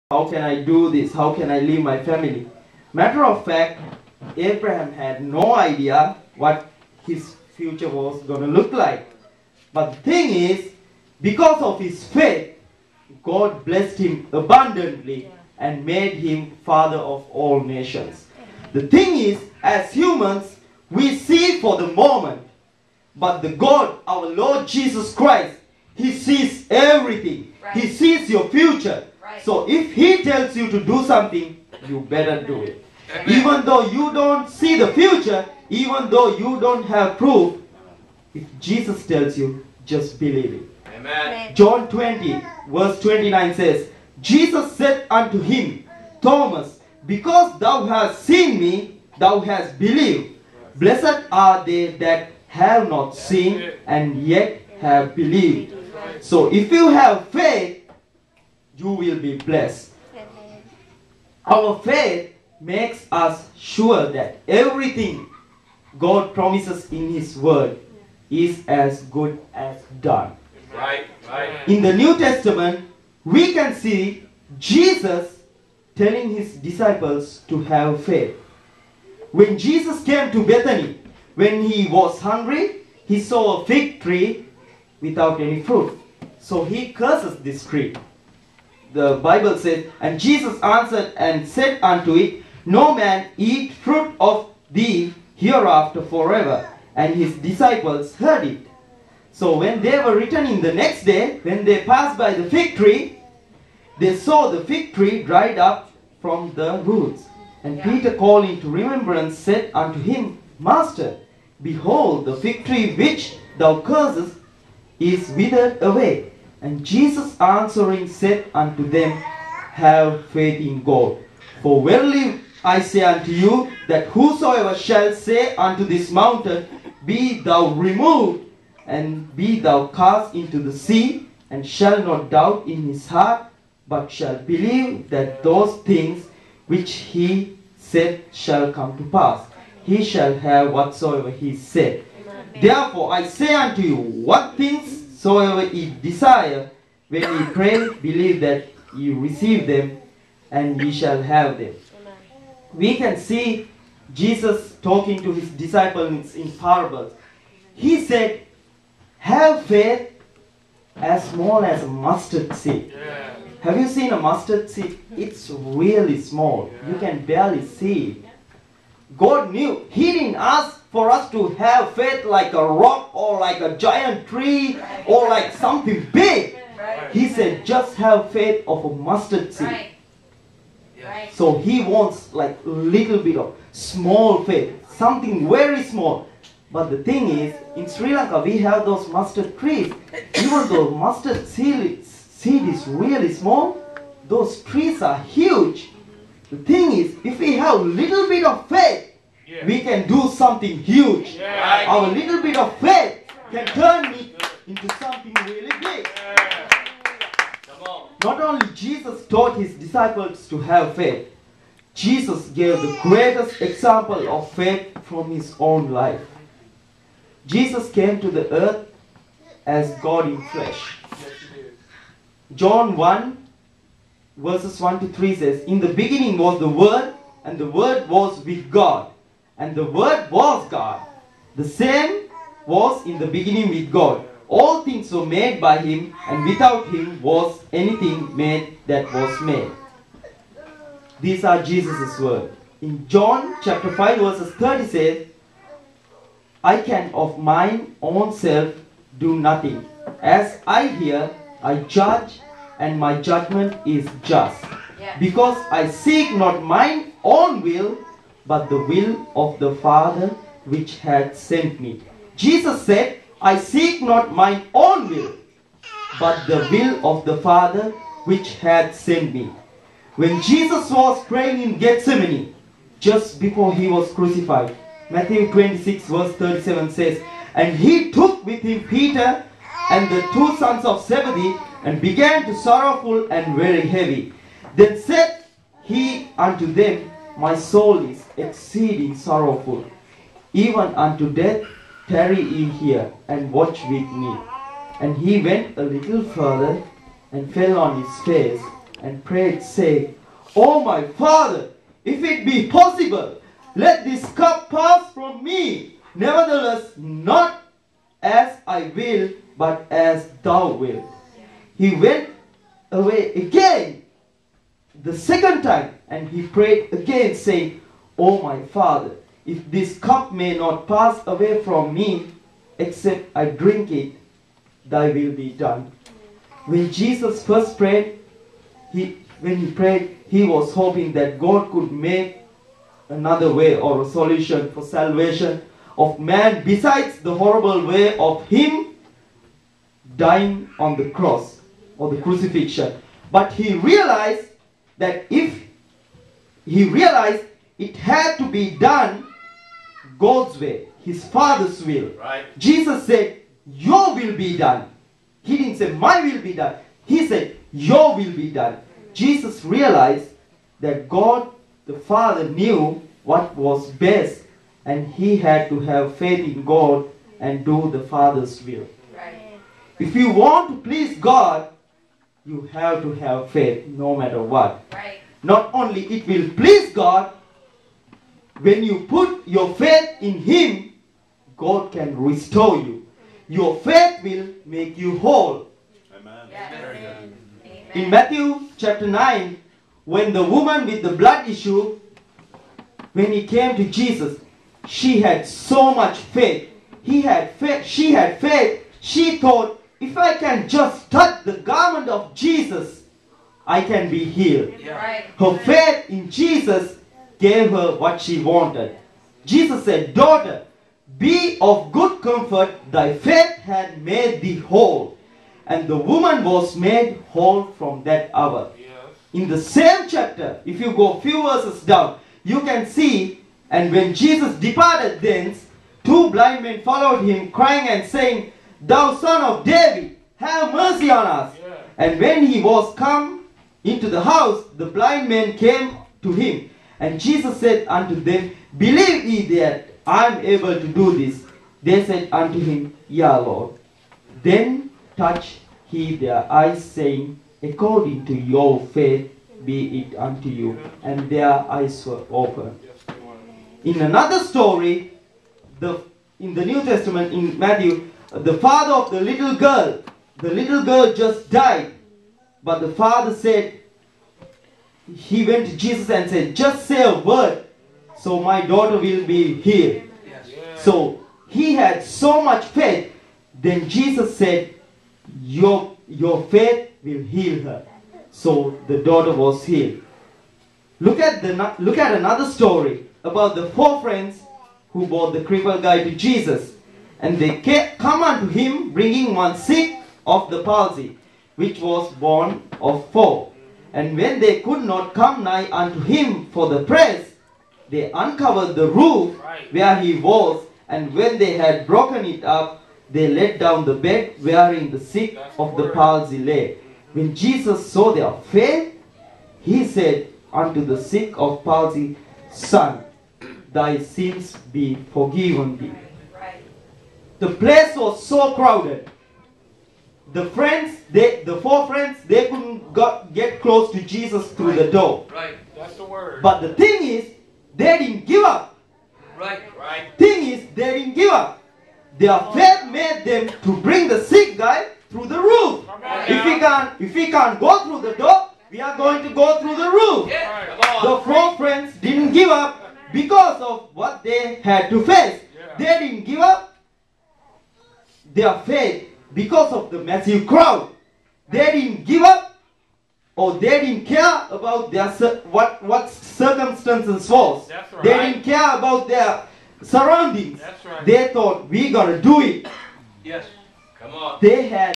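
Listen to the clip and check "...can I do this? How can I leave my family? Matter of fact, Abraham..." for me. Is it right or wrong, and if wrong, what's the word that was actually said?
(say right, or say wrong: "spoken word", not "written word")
right.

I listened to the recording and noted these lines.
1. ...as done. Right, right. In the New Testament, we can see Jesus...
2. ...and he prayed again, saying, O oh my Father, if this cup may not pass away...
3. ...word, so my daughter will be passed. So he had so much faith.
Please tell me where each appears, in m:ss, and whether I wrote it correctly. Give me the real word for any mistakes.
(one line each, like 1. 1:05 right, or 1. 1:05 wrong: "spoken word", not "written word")
1. 1:09 right
2. 5:16 right
3. 7:47 wrong: "healed", not "passed".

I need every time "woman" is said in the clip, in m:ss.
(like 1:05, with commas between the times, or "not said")
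6:30, 6:55.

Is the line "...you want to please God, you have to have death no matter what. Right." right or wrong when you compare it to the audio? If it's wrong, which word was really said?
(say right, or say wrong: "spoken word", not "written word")
wrong: "faith", not "death".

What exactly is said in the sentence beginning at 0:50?
Blessed are they that have not seen and yet have believed.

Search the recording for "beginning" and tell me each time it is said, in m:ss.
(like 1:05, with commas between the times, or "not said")
3:45, 3:53.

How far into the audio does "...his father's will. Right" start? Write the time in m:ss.
5:51.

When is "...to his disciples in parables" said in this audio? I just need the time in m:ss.
2:35.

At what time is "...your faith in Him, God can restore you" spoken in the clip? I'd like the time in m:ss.
6:19.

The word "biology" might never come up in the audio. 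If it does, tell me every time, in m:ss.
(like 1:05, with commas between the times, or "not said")
not said.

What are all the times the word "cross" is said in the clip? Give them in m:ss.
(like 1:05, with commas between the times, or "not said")
5:41.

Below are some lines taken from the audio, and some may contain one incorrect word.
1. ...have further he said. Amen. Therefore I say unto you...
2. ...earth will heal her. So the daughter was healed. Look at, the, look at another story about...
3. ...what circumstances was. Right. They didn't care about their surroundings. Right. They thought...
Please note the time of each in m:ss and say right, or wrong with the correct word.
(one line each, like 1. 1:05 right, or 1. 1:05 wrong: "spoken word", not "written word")
1. 2:20 wrong: "whatsoever", not "further"
2. 7:56 wrong: "faith", not "earth"
3. 9:15 right.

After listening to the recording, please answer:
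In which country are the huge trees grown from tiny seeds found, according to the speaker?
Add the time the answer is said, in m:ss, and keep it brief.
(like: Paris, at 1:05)
Sri Lanka, at 3:07.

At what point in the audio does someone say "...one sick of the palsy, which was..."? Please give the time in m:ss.
8:09.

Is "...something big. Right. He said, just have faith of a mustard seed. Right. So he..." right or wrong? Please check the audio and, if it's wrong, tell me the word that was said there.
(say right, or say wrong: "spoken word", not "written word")
right.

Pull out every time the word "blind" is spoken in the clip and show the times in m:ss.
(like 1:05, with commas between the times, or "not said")
7:06, 7:14.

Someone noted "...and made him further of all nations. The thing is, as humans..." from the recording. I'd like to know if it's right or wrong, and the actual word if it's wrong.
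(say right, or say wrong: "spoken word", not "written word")
wrong: "father", not "further".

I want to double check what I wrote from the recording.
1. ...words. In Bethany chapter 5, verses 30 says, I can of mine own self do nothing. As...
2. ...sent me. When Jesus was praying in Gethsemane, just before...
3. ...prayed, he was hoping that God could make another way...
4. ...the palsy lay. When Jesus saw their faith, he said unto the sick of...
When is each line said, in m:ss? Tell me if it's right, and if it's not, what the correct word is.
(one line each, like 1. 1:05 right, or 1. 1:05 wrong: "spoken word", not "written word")
1. 4:02 wrong: "John", not "Bethany"
2. 4:28 right
3. 5:29 right
4. 8:25 right.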